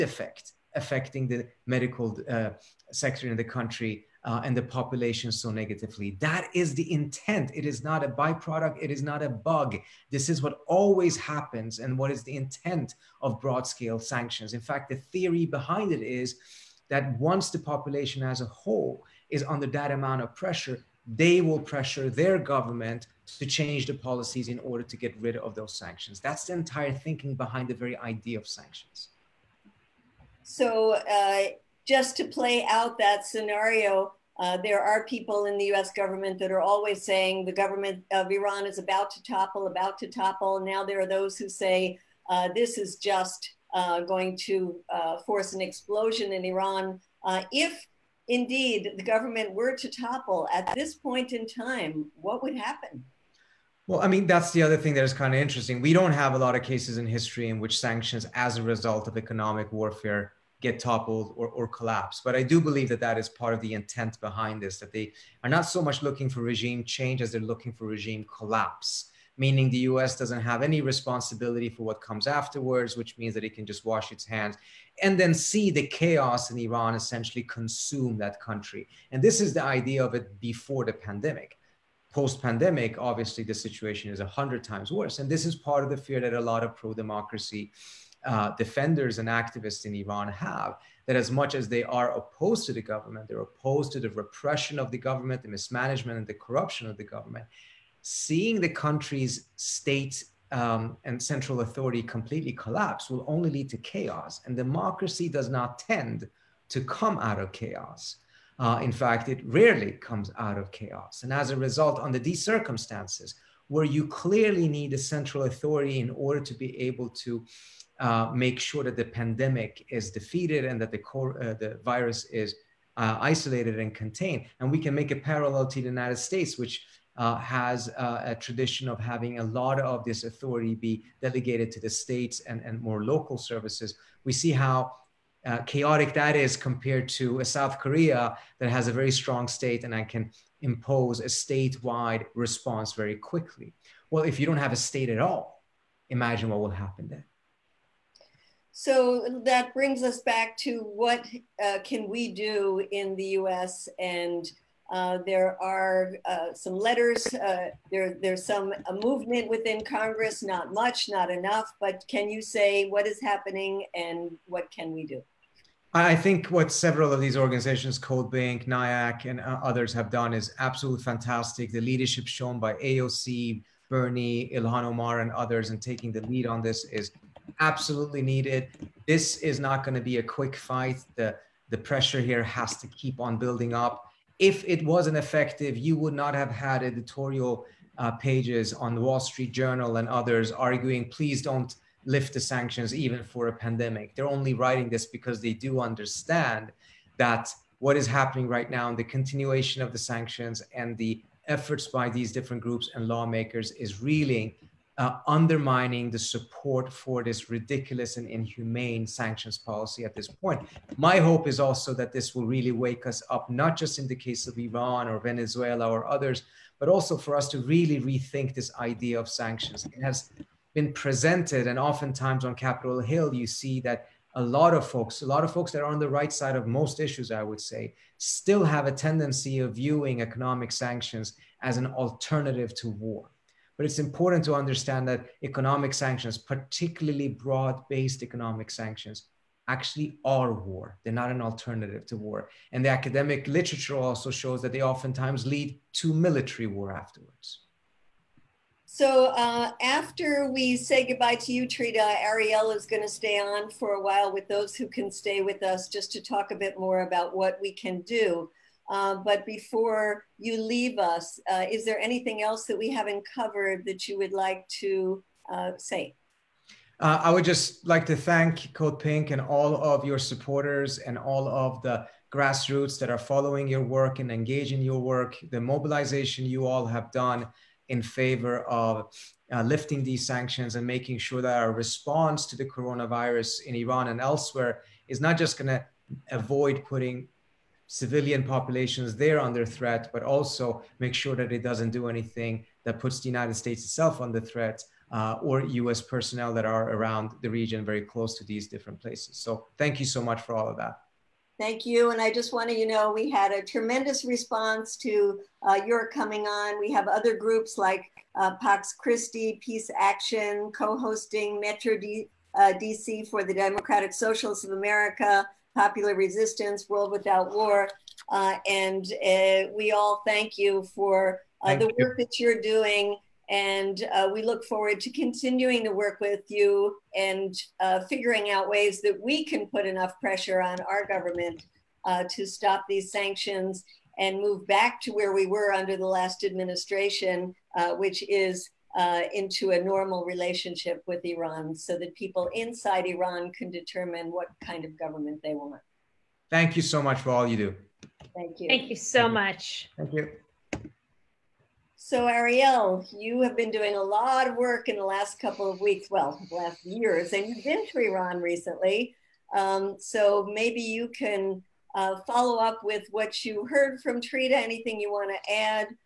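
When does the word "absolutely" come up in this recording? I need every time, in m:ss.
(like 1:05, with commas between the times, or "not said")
2:50, 2:57.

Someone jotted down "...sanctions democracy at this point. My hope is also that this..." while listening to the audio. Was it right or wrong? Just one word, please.
wrong.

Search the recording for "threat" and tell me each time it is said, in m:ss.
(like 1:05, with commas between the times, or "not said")
4:49, 4:54.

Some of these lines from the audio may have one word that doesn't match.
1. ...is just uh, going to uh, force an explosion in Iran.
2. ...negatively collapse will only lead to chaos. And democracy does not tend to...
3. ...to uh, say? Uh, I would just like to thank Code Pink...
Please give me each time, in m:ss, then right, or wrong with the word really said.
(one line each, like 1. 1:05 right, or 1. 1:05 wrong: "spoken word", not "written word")
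1. 0:42 right
2. 1:42 wrong: "completely", not "negatively"
3. 4:24 right.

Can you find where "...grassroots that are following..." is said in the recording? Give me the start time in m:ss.
4:32.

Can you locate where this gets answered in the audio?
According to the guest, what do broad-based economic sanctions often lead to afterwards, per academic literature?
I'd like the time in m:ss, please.
4:06.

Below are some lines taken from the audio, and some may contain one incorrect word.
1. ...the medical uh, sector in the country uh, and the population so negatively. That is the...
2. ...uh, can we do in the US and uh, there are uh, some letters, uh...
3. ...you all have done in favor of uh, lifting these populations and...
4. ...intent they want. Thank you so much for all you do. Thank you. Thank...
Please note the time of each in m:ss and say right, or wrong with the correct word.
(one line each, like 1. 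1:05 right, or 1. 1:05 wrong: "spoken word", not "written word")
1. 0:01 right
2. 2:31 right
3. 4:36 wrong: "sanctions", not "populations"
4. 5:44 wrong: "government", not "intent".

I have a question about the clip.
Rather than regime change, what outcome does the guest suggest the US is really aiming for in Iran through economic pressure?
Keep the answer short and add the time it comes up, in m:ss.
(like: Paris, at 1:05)
Regime collapse, at 1:07.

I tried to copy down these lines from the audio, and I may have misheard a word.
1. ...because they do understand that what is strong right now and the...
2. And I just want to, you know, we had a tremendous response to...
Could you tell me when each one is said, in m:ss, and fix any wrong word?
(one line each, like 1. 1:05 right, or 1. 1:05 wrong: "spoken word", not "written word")
1. 3:15 wrong: "happening", not "strong"
2. 5:02 right.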